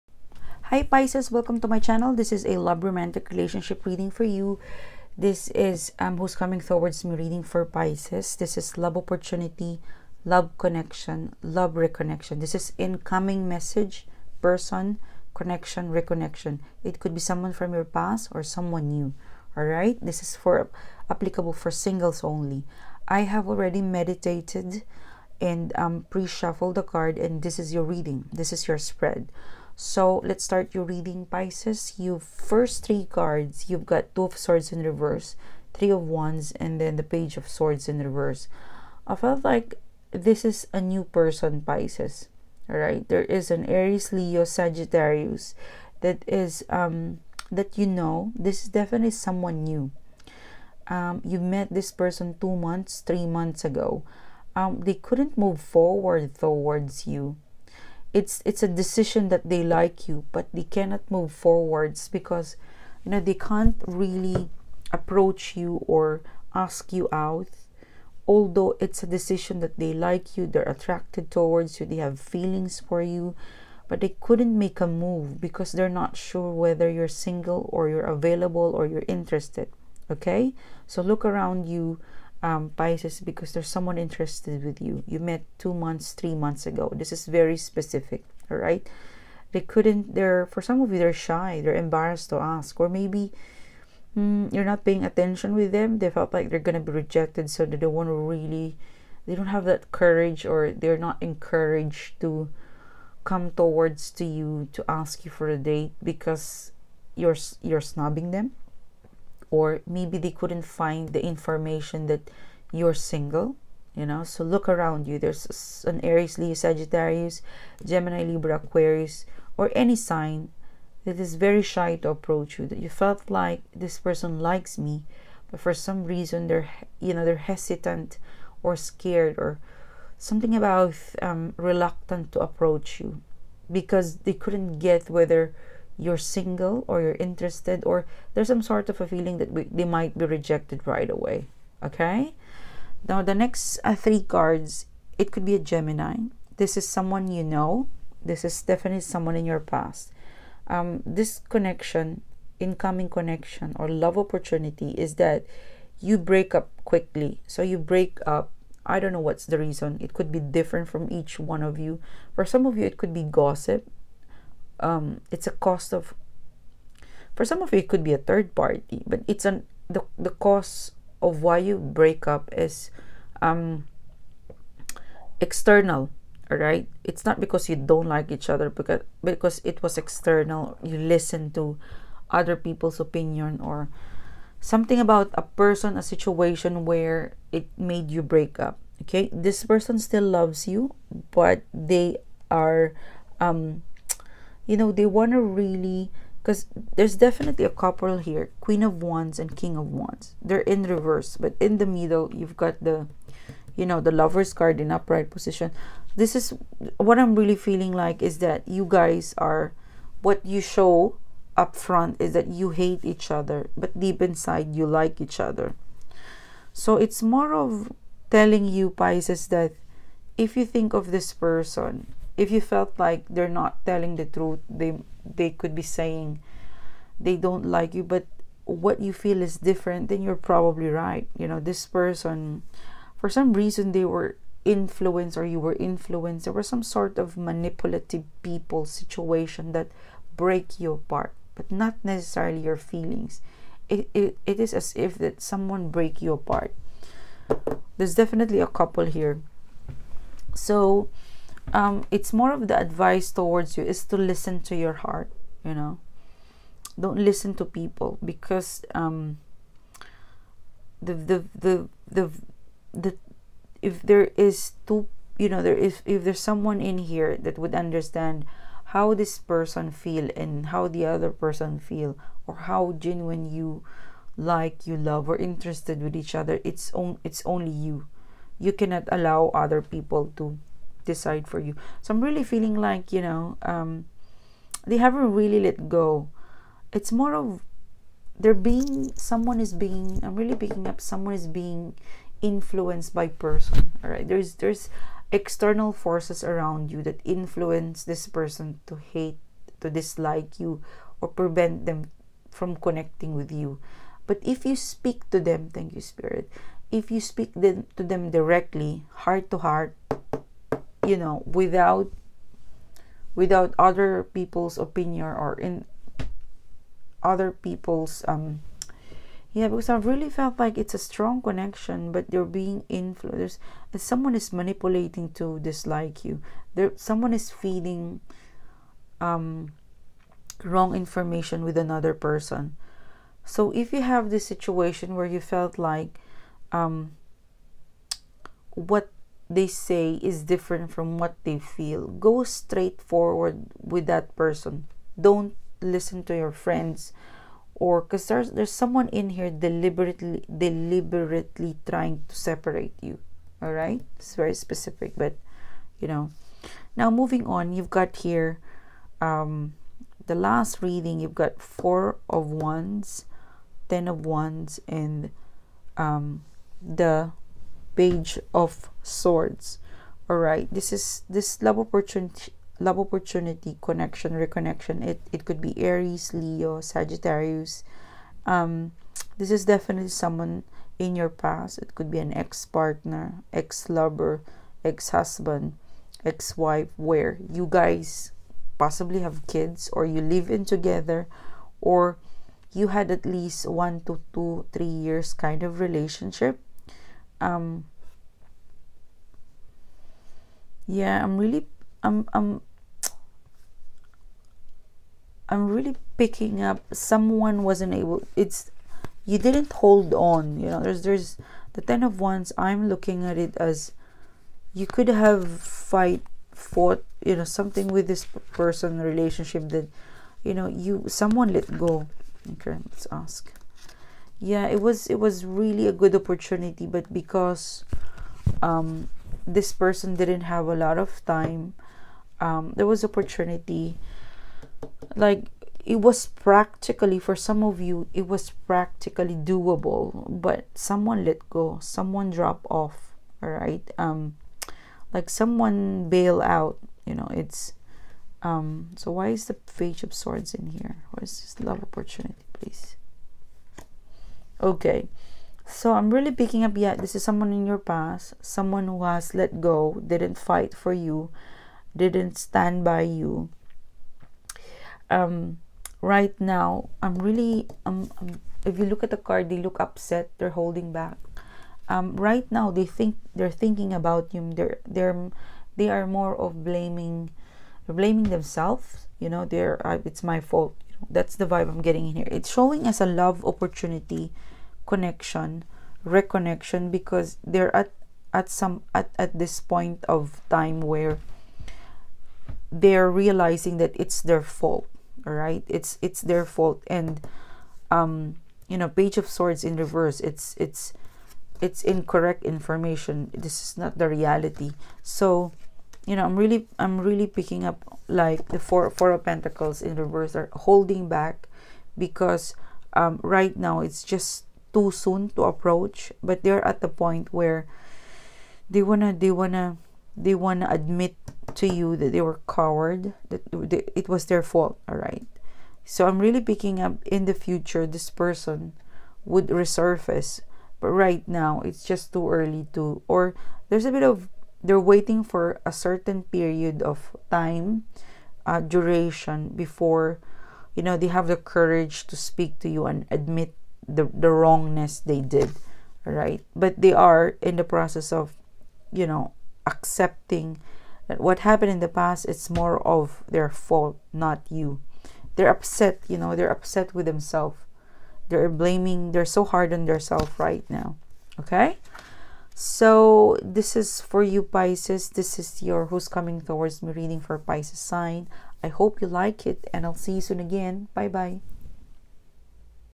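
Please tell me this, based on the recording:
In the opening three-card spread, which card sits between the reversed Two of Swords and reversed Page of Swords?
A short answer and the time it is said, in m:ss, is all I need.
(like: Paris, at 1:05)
Three of Wands, at 0:35.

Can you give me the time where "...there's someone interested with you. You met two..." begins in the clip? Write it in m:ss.
1:23.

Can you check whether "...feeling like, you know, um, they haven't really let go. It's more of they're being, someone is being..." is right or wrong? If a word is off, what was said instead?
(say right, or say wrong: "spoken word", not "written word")
right.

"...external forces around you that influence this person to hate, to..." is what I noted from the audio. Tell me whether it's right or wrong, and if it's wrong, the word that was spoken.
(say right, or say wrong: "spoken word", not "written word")
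right.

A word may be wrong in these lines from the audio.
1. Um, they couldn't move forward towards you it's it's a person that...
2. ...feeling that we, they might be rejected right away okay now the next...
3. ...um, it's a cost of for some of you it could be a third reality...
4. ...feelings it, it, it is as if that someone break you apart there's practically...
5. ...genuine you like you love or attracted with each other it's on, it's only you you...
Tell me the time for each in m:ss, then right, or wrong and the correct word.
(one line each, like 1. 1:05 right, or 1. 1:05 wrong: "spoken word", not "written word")
1. 0:54 wrong: "decision", not "person"
2. 2:19 right
3. 2:44 wrong: "party", not "reality"
4. 4:02 wrong: "definitely", not "practically"
5. 4:32 wrong: "interested", not "attracted".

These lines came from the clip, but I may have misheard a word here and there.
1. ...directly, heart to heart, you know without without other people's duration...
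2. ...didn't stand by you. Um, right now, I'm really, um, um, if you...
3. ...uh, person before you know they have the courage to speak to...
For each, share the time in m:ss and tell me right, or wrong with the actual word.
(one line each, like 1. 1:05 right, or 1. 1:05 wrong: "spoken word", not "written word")
1. 5:08 wrong: "opinion", not "duration"
2. 7:41 right
3. 8:58 wrong: "duration", not "person".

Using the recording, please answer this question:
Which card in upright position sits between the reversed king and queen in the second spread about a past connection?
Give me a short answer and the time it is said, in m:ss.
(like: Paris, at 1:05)
The Lovers, at 3:23.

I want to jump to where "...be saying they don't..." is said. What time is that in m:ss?
3:45.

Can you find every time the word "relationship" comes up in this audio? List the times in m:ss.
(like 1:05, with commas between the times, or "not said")
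0:03, 6:35, 6:58.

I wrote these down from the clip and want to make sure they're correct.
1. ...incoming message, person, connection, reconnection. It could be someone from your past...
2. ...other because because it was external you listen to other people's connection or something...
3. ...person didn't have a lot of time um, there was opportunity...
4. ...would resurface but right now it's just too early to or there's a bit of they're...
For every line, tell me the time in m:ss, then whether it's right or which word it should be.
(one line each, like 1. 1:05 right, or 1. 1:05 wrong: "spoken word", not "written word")
1. 0:12 right
2. 2:58 wrong: "opinion", not "connection"
3. 7:09 right
4. 8:49 right.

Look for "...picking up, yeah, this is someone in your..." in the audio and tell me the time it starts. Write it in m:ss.
7:36.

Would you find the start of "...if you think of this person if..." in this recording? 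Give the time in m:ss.
3:40.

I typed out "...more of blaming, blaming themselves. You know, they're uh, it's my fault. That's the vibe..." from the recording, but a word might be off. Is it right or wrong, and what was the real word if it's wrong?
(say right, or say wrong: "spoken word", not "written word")
right.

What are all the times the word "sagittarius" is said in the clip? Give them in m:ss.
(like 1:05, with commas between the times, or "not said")
0:44, 1:56, 6:16.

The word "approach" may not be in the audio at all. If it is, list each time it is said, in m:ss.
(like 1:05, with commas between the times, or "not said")
1:04, 2:02, 2:12, 8:35.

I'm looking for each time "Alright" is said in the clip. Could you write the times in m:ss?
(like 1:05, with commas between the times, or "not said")
0:42, 5:53.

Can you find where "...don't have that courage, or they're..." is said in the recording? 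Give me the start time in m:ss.
1:39.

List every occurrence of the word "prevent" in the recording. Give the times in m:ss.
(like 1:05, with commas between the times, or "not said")
5:01.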